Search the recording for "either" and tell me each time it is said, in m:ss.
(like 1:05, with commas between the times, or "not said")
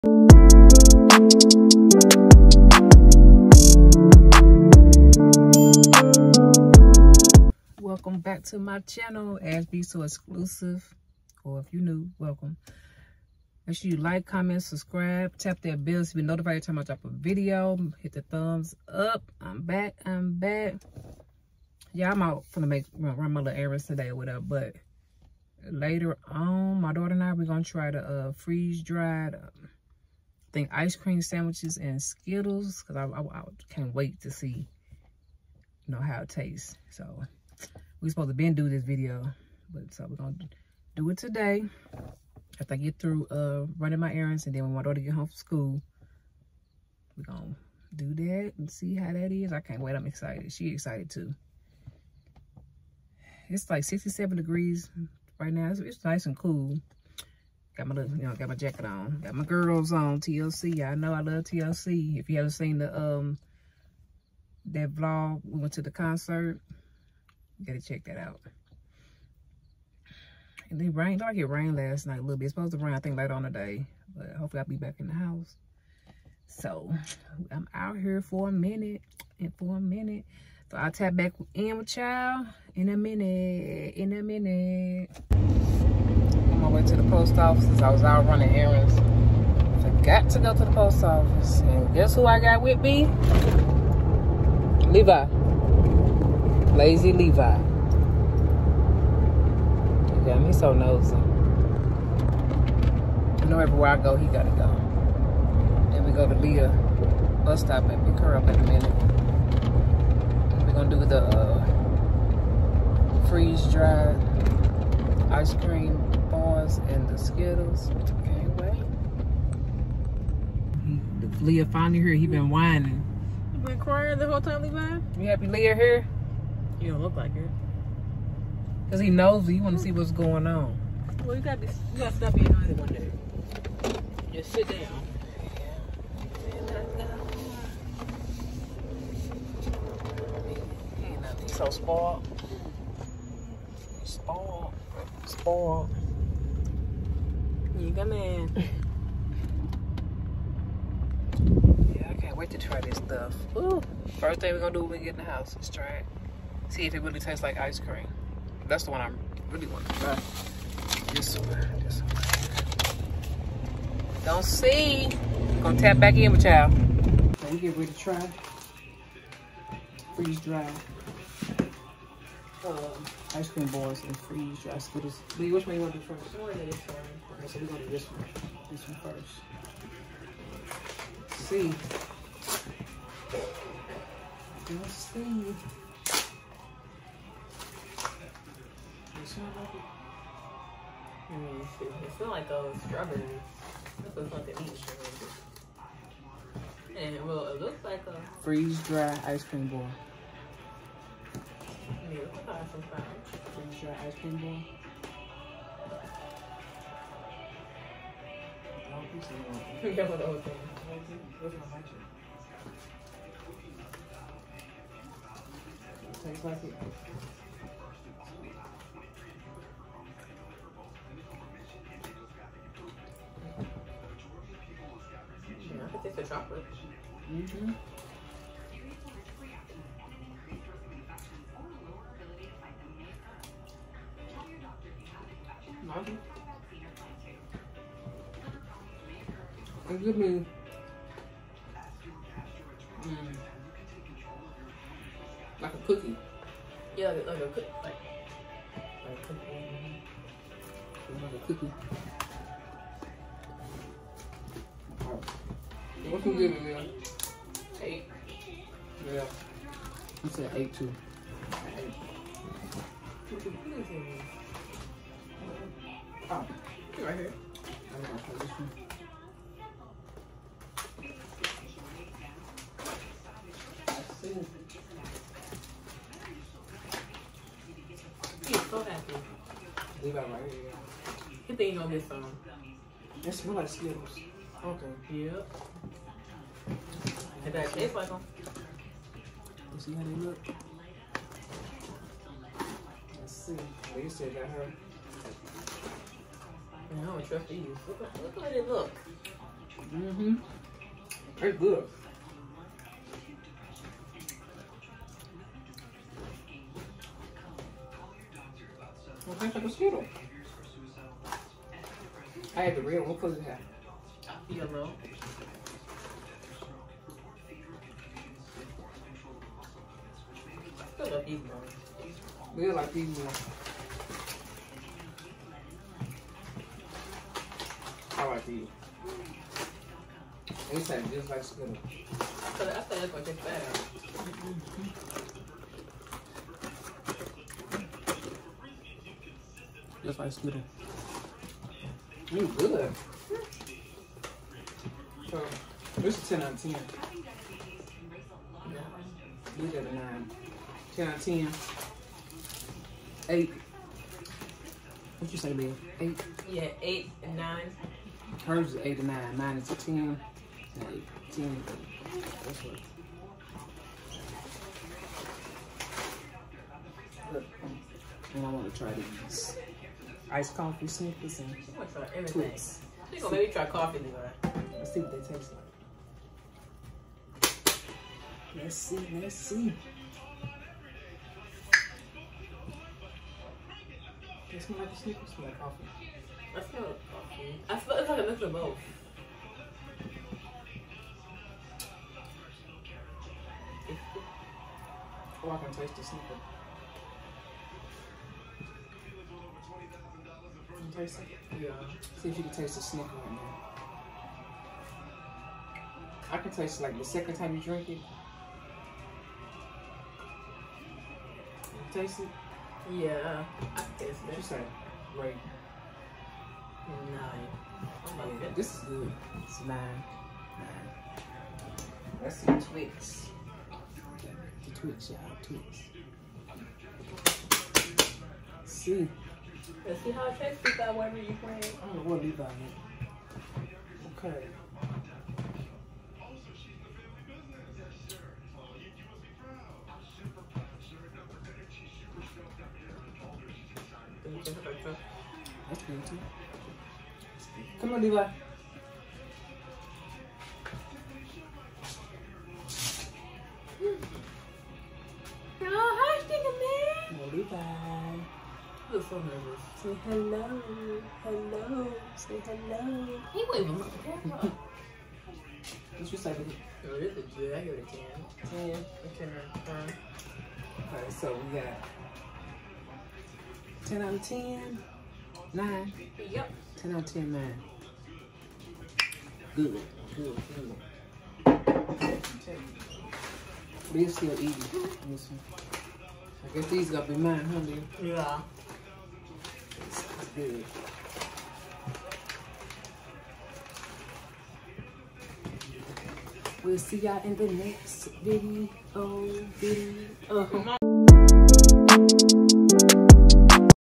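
7:12.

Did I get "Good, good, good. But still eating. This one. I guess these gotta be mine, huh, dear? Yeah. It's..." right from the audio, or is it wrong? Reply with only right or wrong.
right.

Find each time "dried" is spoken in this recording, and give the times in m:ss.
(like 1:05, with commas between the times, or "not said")
0:28, 1:53.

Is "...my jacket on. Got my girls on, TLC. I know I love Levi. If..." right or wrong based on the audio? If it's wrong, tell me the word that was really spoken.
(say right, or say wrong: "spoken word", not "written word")
wrong: "TLC", not "Levi".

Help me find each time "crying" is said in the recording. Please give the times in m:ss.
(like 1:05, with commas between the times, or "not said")
2:03.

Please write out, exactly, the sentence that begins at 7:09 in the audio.
Let's see how it tastes that whatever you playing.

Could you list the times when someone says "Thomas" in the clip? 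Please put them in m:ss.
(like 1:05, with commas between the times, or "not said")
not said.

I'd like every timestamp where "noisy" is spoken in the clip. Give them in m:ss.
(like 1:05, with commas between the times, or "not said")
2:12.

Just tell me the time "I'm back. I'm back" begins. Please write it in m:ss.
0:19.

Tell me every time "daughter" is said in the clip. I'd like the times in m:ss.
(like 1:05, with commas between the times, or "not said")
0:26, 0:44.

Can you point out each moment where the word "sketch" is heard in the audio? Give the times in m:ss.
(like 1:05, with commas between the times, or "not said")
not said.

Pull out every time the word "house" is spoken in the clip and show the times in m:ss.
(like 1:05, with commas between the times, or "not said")
1:15, 2:35.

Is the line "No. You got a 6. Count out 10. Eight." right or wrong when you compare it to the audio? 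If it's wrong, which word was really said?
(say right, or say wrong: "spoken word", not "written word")
wrong: "9", not "6".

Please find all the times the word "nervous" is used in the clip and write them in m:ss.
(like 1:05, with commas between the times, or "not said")
7:39.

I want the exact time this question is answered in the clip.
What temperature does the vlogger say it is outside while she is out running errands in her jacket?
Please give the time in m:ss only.
0:53.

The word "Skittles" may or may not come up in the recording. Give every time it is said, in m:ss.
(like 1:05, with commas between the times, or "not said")
0:32, 1:57, 2:54, 4:43, 5:09, 5:40.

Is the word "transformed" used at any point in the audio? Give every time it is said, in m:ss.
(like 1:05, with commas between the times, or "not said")
not said.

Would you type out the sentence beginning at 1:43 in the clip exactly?
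I know everywhere I go, he gotta go.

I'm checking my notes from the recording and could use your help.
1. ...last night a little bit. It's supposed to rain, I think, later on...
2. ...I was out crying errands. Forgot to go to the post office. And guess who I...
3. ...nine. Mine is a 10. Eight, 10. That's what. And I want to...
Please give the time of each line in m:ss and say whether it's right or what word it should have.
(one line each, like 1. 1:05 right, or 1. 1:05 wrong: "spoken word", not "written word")
1. 1:11 right
2. 1:27 wrong: "running", not "crying"
3. 5:59 right.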